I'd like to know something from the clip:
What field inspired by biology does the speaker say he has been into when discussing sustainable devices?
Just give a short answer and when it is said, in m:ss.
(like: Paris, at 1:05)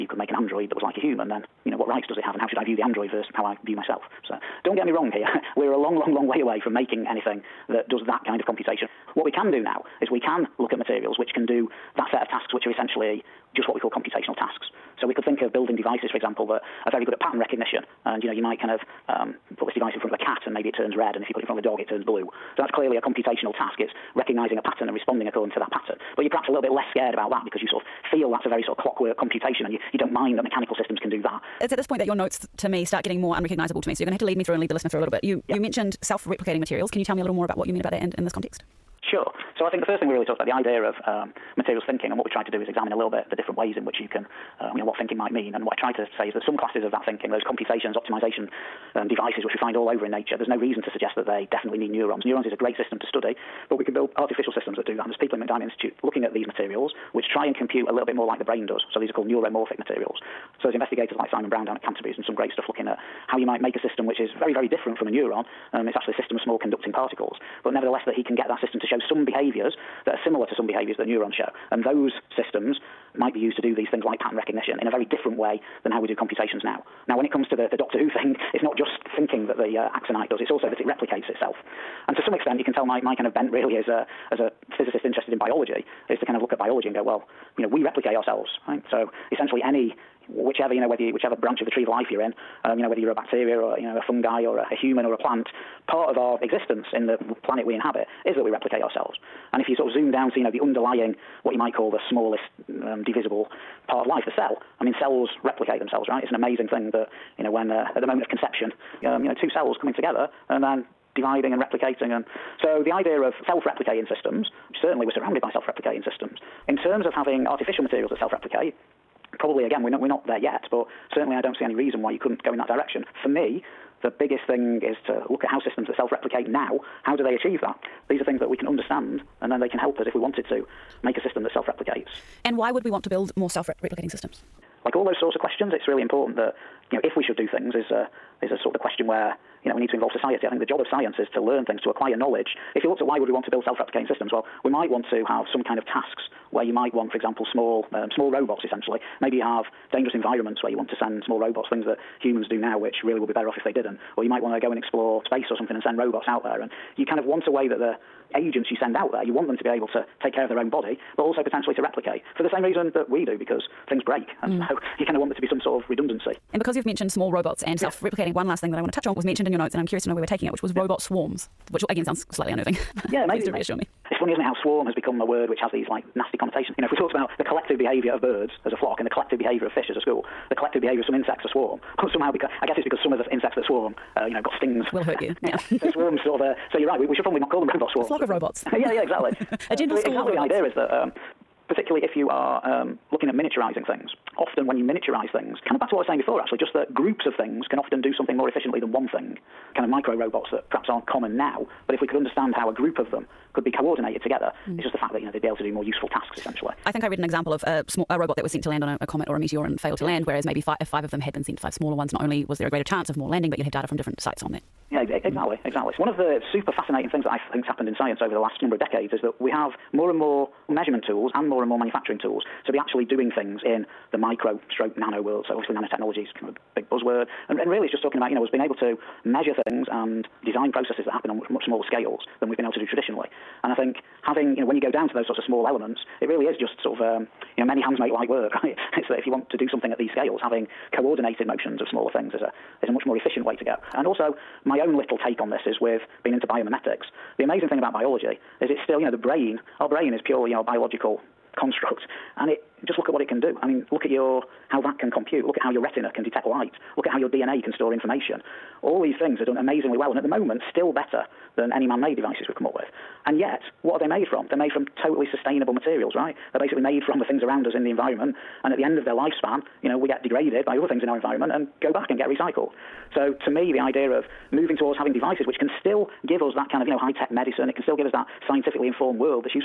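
biomimetics, at 4:06.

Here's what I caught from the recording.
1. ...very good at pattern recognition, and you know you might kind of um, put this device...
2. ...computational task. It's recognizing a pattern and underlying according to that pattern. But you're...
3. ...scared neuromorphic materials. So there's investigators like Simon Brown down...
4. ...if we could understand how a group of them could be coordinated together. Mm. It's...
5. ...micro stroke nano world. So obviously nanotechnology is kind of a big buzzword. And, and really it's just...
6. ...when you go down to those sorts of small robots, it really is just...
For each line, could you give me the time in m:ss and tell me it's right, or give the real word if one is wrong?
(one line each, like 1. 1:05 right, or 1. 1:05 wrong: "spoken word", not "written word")
1. 0:16 right
2. 0:22 wrong: "responding", not "underlying"
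3. 0:59 wrong: "called", not "scared"
4. 3:21 right
5. 3:44 right
6. 3:54 wrong: "elements", not "robots".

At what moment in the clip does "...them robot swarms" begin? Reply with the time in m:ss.
3:07.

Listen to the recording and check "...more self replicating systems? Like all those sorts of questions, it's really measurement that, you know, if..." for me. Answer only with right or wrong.
wrong.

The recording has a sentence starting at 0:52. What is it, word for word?
Neurons is a great system to study but we can build artificial systems that do that.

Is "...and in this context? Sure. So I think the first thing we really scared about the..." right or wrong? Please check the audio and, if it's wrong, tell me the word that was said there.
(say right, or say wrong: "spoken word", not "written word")
wrong: "talked", not "scared".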